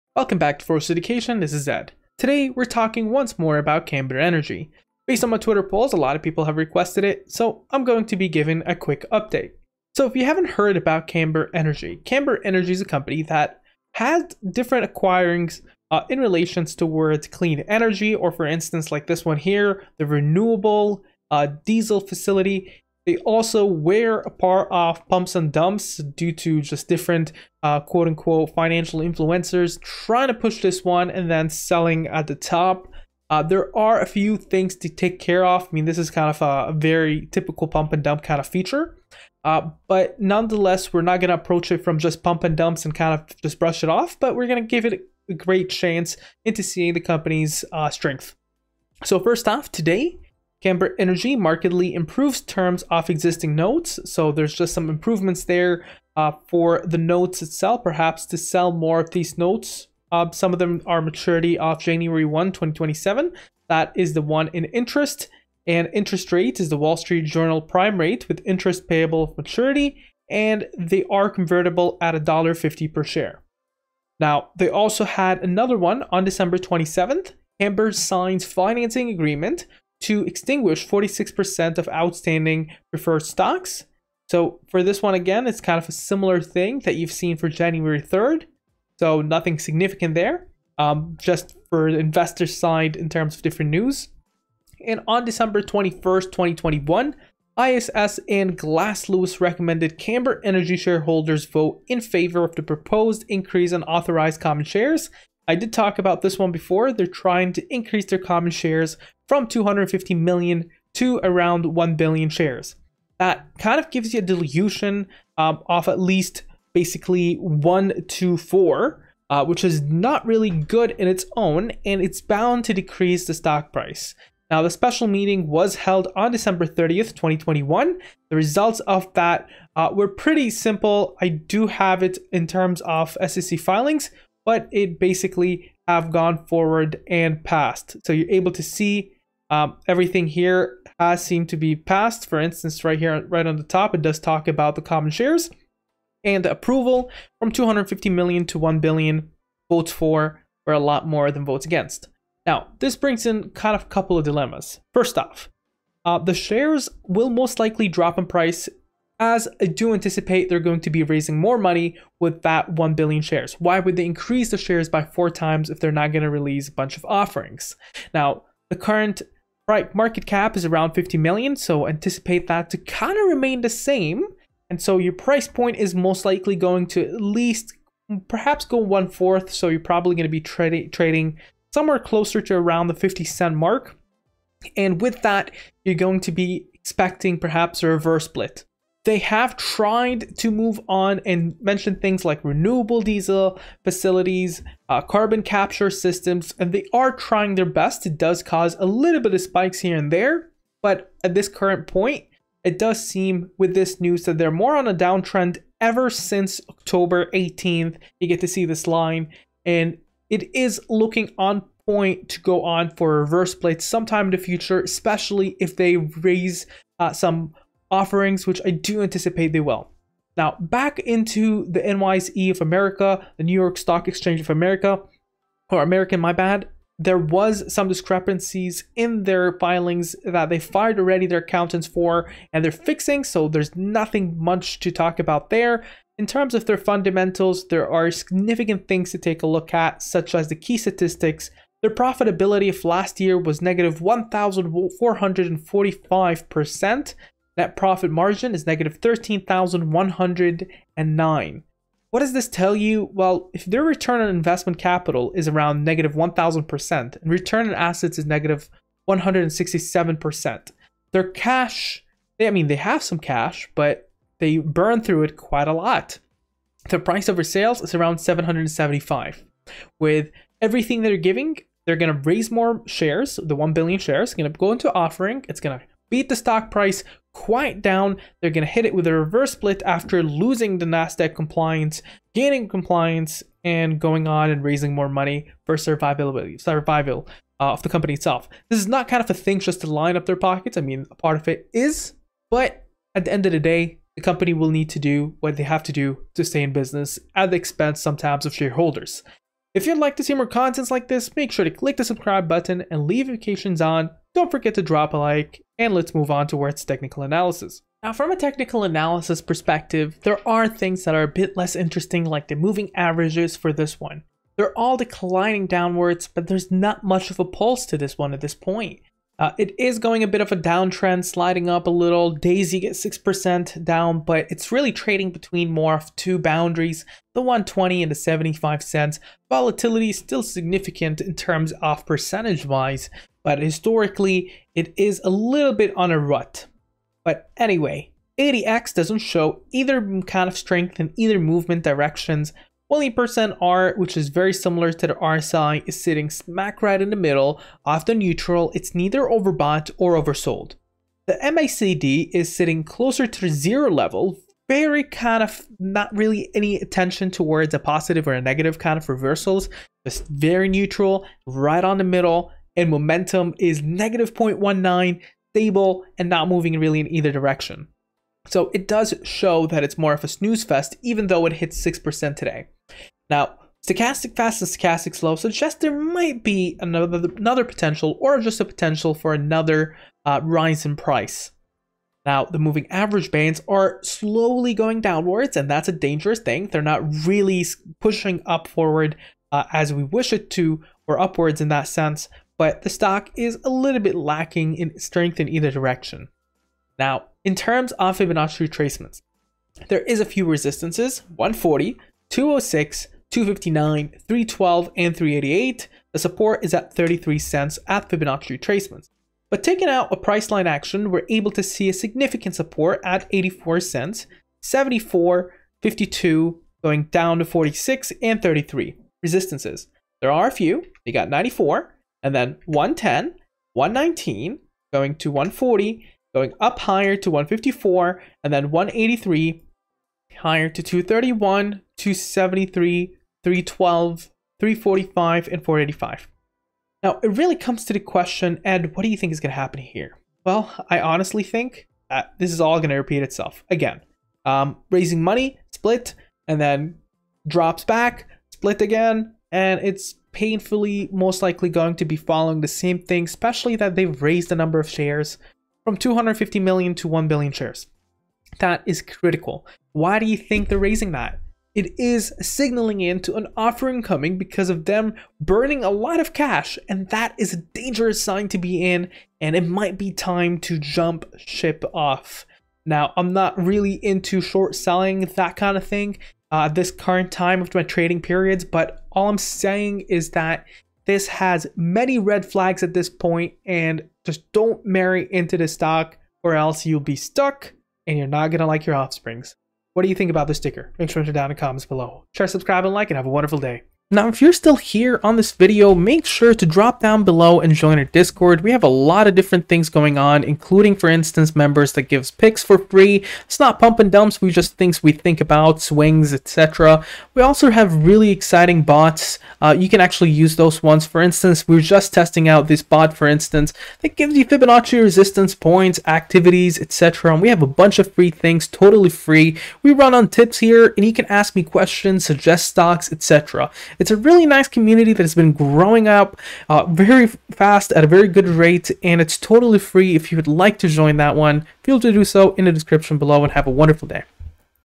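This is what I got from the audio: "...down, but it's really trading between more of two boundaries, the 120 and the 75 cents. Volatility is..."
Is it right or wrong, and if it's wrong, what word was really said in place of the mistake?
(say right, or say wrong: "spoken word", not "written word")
right.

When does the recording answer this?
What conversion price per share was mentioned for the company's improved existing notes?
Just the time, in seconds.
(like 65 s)
72 s.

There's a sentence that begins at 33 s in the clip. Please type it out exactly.
Uh, there are a few things to take care of.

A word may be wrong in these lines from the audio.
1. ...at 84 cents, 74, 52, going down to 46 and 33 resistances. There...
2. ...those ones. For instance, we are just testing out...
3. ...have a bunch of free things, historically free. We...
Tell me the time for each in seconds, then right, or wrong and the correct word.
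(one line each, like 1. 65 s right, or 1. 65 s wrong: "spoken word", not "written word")
1. 413 s right
2. 510 s right
3. 517 s wrong: "totally", not "historically".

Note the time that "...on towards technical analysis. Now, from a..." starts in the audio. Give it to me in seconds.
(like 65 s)
306 s.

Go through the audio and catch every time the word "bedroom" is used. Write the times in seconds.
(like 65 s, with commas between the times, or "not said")
not said.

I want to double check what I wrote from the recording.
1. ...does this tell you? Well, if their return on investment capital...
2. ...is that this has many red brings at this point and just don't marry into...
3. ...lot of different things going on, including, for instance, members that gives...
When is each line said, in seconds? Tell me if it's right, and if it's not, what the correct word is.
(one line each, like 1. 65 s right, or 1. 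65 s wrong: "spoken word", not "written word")
1. 252 s right
2. 480 s wrong: "flags", not "brings"
3. 498 s right.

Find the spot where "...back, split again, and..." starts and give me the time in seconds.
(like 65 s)
447 s.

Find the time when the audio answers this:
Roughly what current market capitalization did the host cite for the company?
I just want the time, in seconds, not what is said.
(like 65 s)
170 s.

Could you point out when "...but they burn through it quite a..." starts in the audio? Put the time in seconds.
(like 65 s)
263 s.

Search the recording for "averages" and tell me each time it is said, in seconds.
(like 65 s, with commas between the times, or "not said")
312 s, 382 s.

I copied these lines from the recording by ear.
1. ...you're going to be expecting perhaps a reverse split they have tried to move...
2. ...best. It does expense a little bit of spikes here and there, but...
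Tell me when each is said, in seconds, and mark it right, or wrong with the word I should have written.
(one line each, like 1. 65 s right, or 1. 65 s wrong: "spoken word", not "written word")
1. 185 s right
2. 197 s wrong: "cause", not "expense".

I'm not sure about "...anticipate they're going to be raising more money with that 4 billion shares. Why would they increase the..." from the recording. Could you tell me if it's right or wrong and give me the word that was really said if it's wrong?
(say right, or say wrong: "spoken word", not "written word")
wrong: "1", not "4".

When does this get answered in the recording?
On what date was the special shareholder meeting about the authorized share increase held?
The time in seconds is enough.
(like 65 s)
126 s.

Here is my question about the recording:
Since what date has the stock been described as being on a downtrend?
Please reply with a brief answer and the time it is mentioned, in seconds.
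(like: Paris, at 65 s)
October 18th, at 206 s.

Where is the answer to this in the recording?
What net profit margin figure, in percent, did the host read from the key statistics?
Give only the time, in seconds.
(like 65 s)
248 s.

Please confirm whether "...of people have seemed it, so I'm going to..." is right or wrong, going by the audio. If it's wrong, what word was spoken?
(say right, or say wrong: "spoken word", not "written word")
wrong: "requested", not "seemed".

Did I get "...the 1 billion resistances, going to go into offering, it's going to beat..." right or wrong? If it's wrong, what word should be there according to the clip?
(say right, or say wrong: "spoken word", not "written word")
wrong: "shares", not "resistances".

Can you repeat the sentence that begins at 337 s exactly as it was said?
But anyway, ADX doesn't show either kind of strength in either movement directions.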